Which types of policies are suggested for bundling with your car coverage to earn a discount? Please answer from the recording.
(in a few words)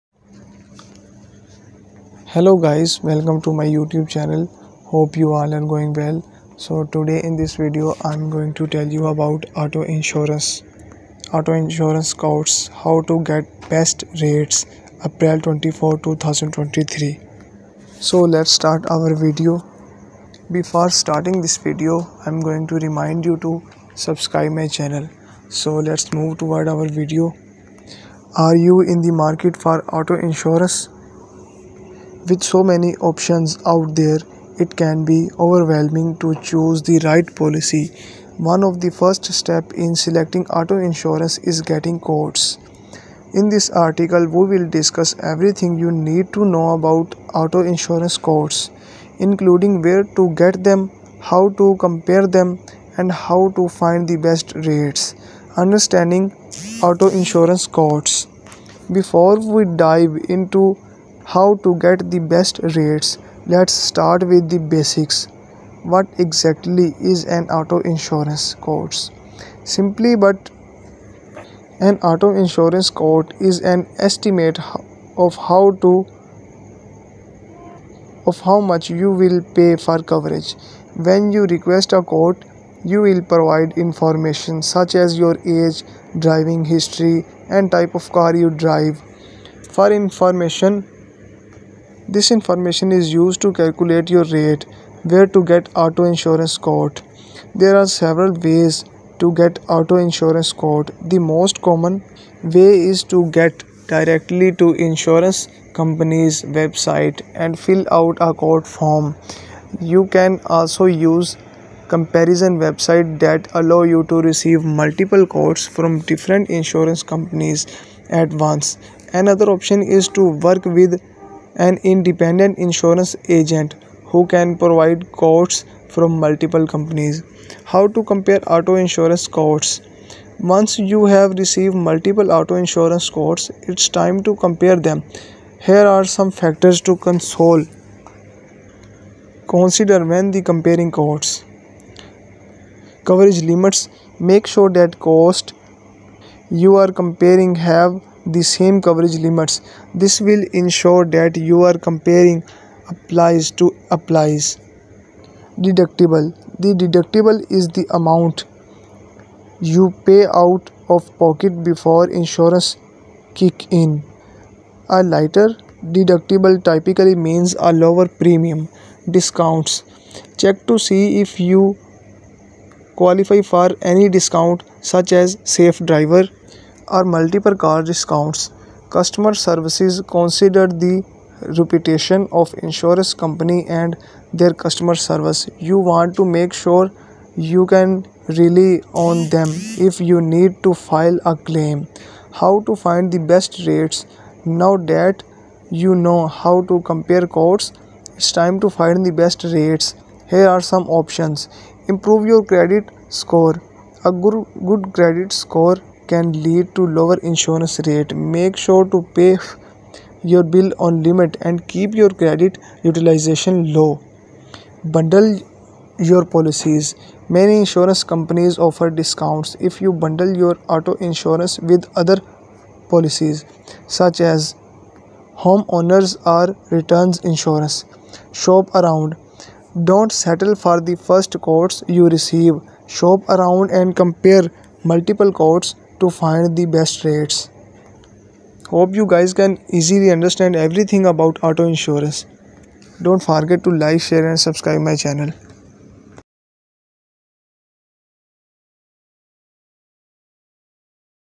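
Homeowners or renters insurance.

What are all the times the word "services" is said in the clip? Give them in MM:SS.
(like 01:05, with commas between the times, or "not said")
02:59, 03:04.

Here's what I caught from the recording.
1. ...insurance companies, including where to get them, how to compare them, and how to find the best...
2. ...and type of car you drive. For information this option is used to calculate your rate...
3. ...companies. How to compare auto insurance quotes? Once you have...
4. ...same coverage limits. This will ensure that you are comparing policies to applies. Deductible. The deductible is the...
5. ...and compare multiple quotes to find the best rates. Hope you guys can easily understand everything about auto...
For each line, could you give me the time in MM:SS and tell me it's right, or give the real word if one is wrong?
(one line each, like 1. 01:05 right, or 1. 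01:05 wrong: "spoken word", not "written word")
1. 00:47 wrong: "quotes", not "companies"
2. 01:27 wrong: "information", not "option"
3. 02:06 right
4. 02:28 wrong: "applies", not "policies"
5. 03:53 right.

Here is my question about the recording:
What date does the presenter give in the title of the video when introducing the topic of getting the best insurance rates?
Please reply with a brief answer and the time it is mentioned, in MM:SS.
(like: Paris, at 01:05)
April 24, 2023, at 00:15.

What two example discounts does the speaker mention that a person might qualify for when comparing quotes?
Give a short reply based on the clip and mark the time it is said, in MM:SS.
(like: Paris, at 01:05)
Safe driver or multiple car, at 02:55.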